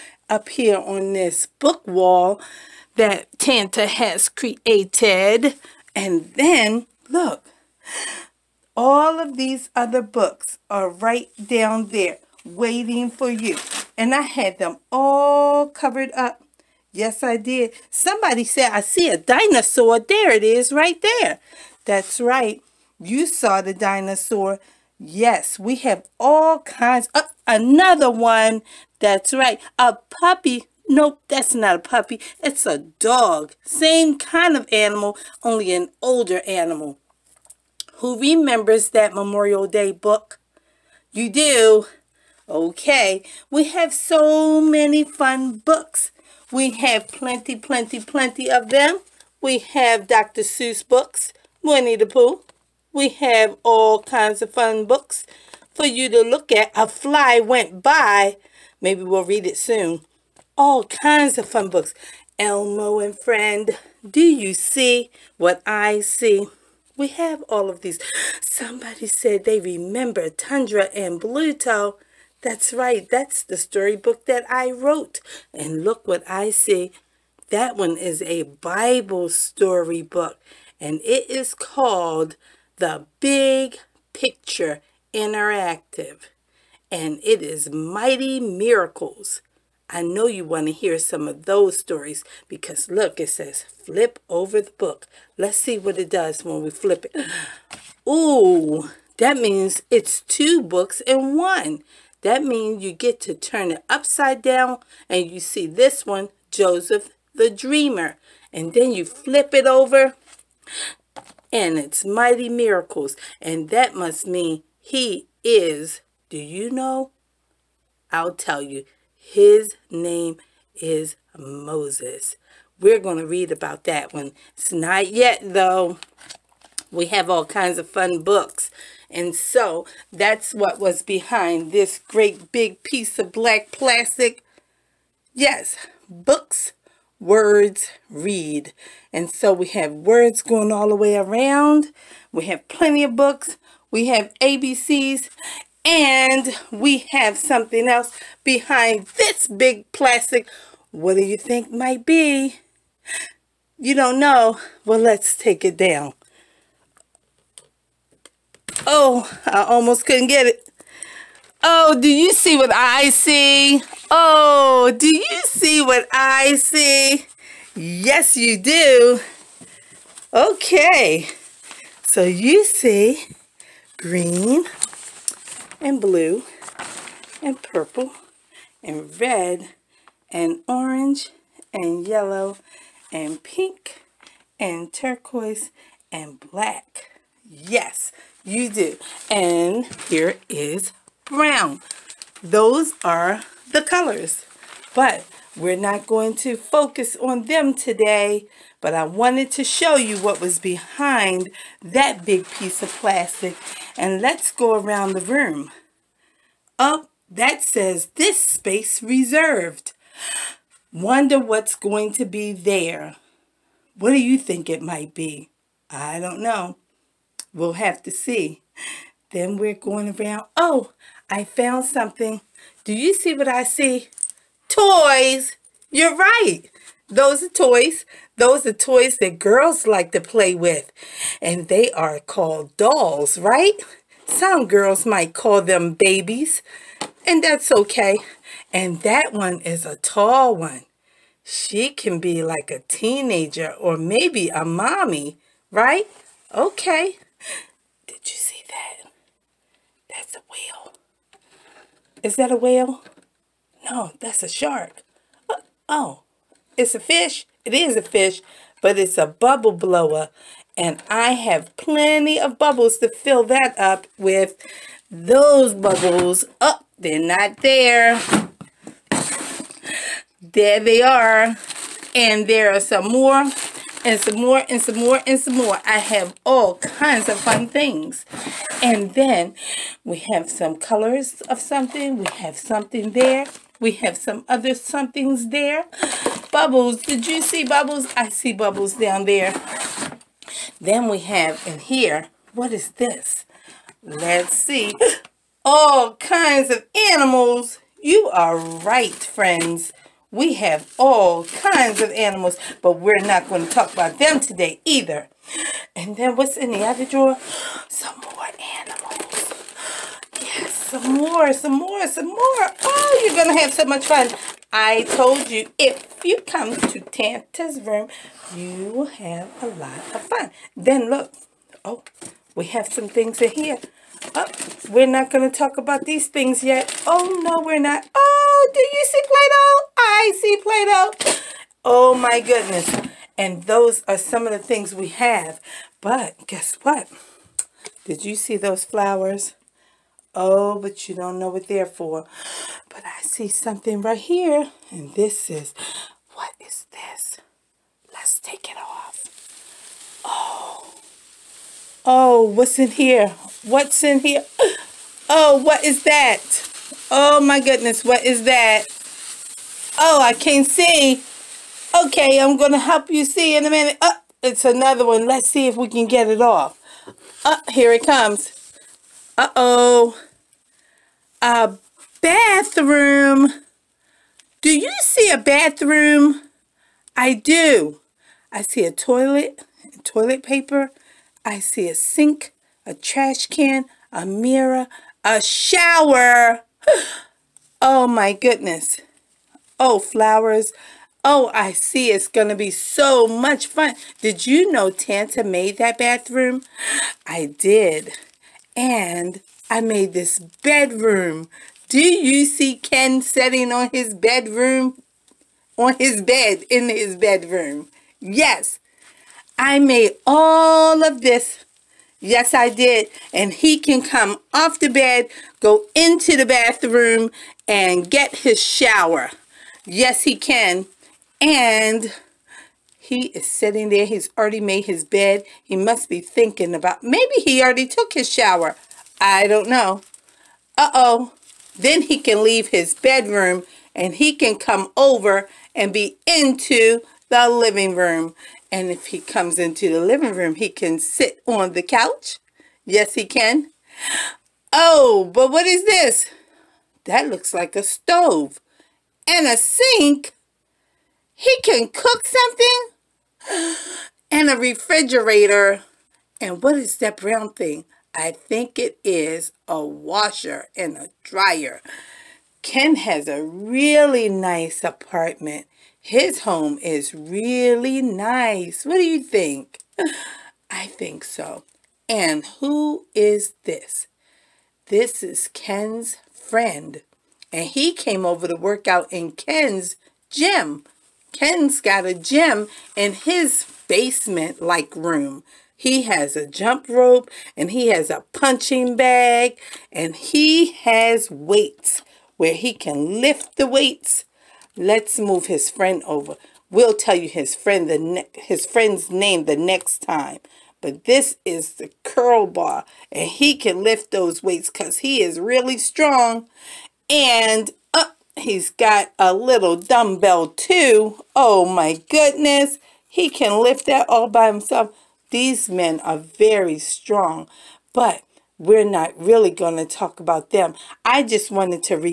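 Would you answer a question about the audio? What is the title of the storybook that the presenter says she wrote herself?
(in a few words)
Tundra and Bluto.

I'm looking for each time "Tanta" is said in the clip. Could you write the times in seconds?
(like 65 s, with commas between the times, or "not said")
3 s, 316 s, 394 s.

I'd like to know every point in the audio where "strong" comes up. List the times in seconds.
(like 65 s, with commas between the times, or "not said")
505 s, 516 s.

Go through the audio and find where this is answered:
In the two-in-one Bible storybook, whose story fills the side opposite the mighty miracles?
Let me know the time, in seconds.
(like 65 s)
106 s.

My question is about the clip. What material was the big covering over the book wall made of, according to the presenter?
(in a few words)
black plastic.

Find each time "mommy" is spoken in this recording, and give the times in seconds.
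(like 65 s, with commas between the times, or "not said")
244 s.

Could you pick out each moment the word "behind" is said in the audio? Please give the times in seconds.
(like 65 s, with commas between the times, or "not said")
131 s, 148 s, 200 s.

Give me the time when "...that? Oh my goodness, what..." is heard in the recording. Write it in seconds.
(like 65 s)
356 s.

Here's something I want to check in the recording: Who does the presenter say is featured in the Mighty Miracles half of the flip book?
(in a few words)
Moses.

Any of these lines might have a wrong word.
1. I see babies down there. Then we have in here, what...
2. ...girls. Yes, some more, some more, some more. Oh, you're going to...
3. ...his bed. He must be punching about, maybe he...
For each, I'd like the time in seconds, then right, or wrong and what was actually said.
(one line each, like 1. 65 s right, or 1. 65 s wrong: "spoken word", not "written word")
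1. 288 s wrong: "bubbles", not "babies"
2. 308 s wrong: "animals", not "girls"
3. 424 s wrong: "thinking", not "punching".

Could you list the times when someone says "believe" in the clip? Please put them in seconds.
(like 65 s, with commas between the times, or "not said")
not said.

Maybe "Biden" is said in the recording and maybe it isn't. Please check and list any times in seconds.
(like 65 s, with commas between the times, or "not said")
not said.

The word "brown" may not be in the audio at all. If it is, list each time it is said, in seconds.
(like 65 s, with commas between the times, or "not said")
191 s, 457 s.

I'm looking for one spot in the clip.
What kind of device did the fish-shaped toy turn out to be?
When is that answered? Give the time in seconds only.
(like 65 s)
259 s.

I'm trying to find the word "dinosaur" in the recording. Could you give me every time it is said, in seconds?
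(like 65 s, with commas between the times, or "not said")
19 s, 23 s.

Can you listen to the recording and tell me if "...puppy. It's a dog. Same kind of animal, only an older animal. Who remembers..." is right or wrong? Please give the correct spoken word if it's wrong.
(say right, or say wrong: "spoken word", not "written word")
right.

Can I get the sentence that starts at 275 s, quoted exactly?
I have all kinds of fun things.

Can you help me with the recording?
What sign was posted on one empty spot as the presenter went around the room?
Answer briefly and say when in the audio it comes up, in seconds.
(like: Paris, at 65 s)
this space reserved, at 208 s.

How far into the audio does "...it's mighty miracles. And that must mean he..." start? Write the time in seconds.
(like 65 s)
111 s.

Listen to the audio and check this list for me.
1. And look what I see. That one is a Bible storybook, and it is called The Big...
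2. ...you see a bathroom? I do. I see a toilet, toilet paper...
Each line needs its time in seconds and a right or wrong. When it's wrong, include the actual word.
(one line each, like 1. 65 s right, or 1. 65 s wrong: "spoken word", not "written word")
1. 75 s right
2. 374 s right.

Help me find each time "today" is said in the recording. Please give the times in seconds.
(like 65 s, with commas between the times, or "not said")
197 s, 304 s.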